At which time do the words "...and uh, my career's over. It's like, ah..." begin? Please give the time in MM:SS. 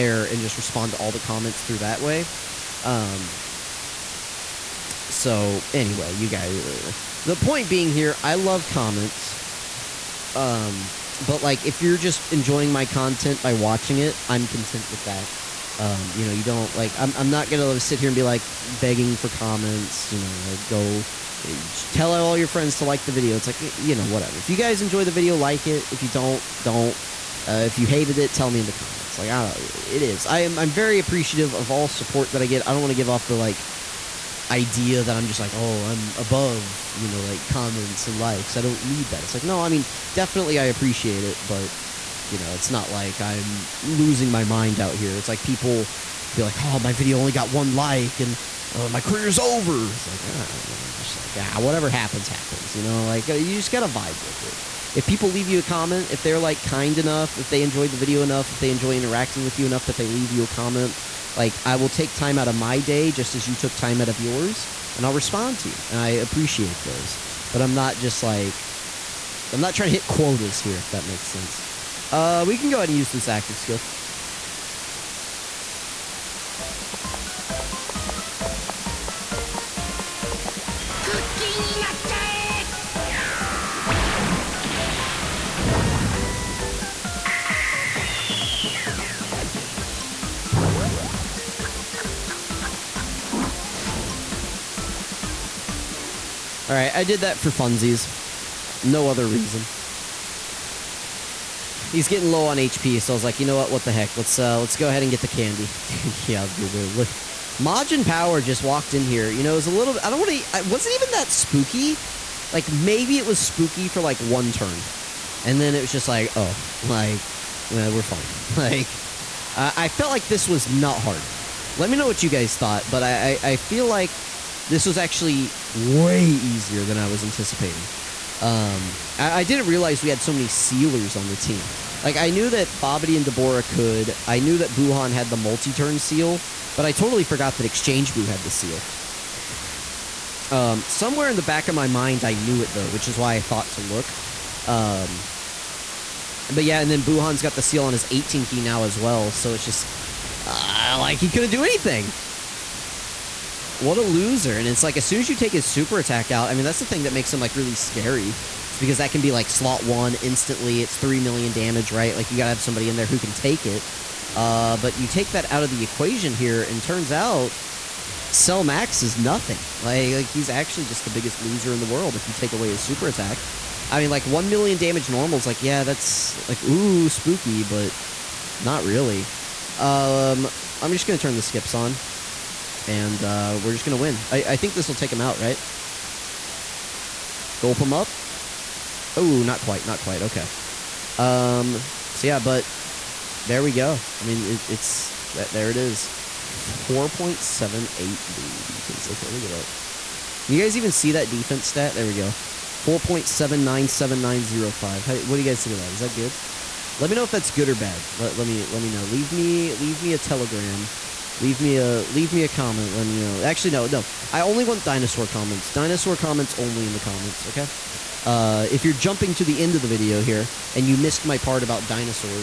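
00:48.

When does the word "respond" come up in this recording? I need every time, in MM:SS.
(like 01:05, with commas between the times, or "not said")
00:00, 01:05.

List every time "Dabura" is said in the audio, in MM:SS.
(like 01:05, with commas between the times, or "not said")
02:13.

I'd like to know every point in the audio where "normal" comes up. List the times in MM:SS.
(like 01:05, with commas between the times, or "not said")
02:55.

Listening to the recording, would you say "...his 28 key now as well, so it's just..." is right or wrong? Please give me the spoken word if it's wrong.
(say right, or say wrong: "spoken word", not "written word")
wrong: "18", not "28".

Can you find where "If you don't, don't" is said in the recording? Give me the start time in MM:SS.
00:25.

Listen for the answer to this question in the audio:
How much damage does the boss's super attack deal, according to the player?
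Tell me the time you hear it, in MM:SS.
02:40.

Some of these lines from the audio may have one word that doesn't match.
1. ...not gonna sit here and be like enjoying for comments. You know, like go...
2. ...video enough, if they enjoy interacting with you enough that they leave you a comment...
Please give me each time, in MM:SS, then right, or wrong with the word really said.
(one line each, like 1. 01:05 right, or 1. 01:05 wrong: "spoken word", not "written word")
1. 00:17 wrong: "begging", not "enjoying"
2. 00:57 right.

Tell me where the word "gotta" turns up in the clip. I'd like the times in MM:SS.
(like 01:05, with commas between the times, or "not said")
00:53, 02:42.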